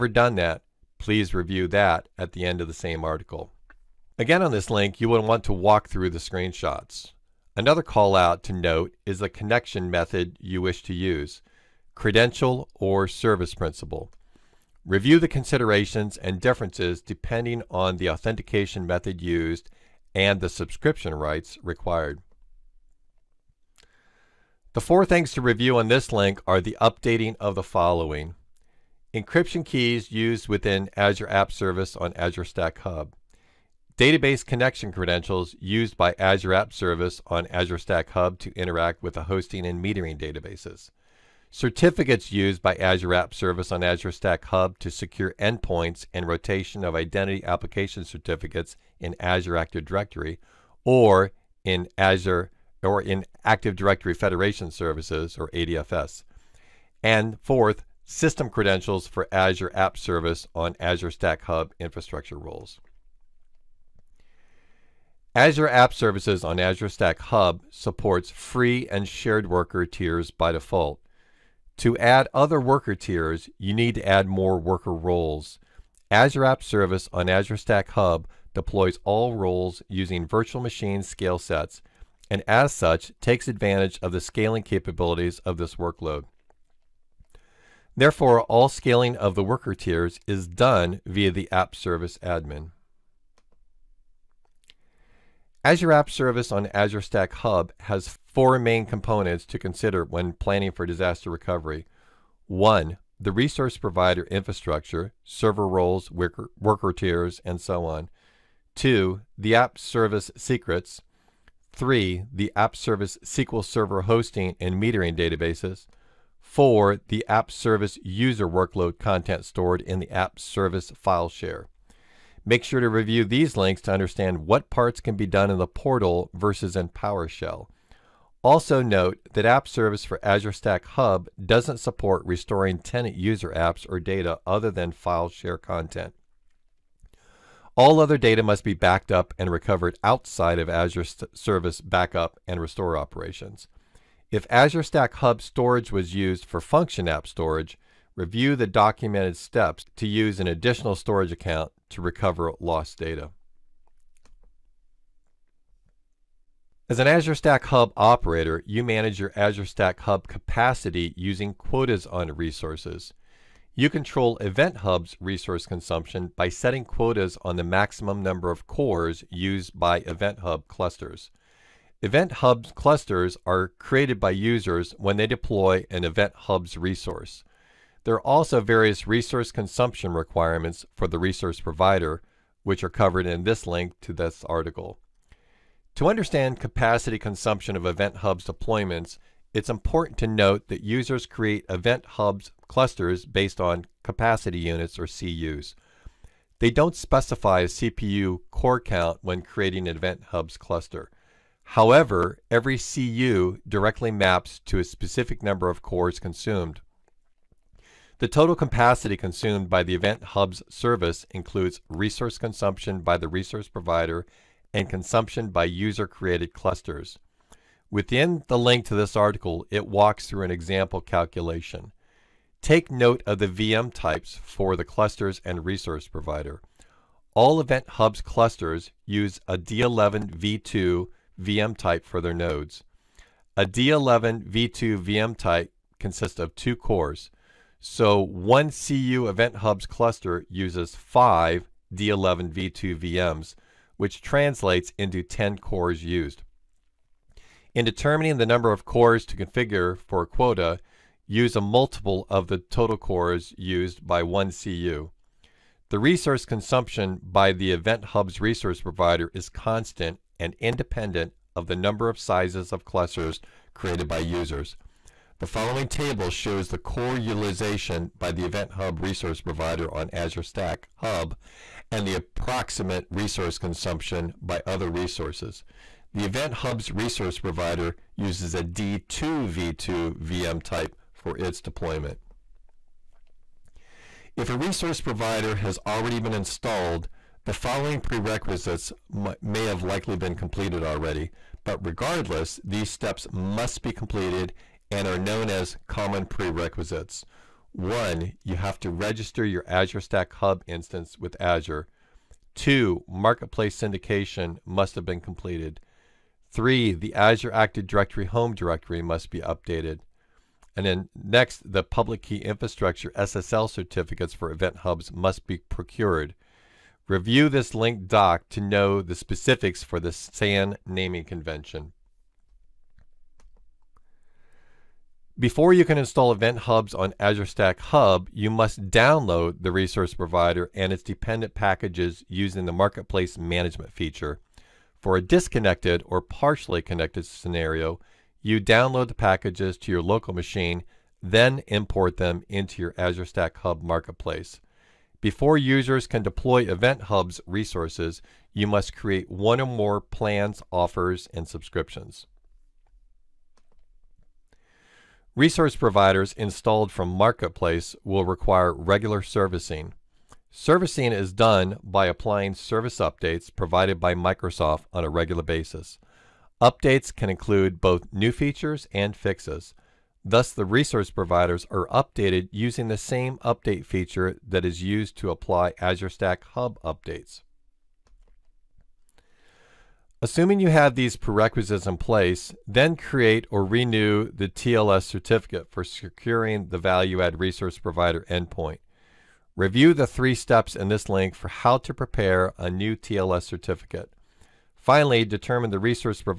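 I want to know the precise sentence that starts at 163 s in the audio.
You control Event Hub's resource consumption by setting quotas on the maximum number of cores used by Event Hub clusters.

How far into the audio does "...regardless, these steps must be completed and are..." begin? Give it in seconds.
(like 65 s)
291 s.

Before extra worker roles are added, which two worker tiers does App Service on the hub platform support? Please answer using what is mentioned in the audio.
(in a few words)
Free and shared.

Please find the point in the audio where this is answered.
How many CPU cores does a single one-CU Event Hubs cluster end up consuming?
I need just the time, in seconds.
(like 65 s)
245 s.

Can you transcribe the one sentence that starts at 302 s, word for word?
Two, marketplace syndication must have been completed.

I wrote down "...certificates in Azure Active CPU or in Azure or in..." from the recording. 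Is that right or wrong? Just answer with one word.
wrong.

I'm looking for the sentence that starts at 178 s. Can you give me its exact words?
There are also various resource consumption requirements for the resource provider, which are covered in this link to this article.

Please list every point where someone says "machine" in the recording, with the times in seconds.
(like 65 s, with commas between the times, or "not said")
80 s, 340 s.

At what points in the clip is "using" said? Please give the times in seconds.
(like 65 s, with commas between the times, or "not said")
79 s, 161 s, 332 s, 372 s.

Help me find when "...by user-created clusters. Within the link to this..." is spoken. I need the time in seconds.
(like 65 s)
215 s.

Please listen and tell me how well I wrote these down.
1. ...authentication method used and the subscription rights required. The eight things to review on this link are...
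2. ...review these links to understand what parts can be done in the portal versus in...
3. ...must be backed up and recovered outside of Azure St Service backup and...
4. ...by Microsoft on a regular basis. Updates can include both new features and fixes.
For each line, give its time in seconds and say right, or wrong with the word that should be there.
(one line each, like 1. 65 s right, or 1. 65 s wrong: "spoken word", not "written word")
1. 18 s wrong: "four", not "eight"
2. 122 s right
3. 138 s right
4. 363 s right.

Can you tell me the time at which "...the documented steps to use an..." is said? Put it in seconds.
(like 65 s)
148 s.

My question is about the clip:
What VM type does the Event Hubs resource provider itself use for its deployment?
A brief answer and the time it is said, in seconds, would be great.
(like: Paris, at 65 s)
D2v2, at 278 s.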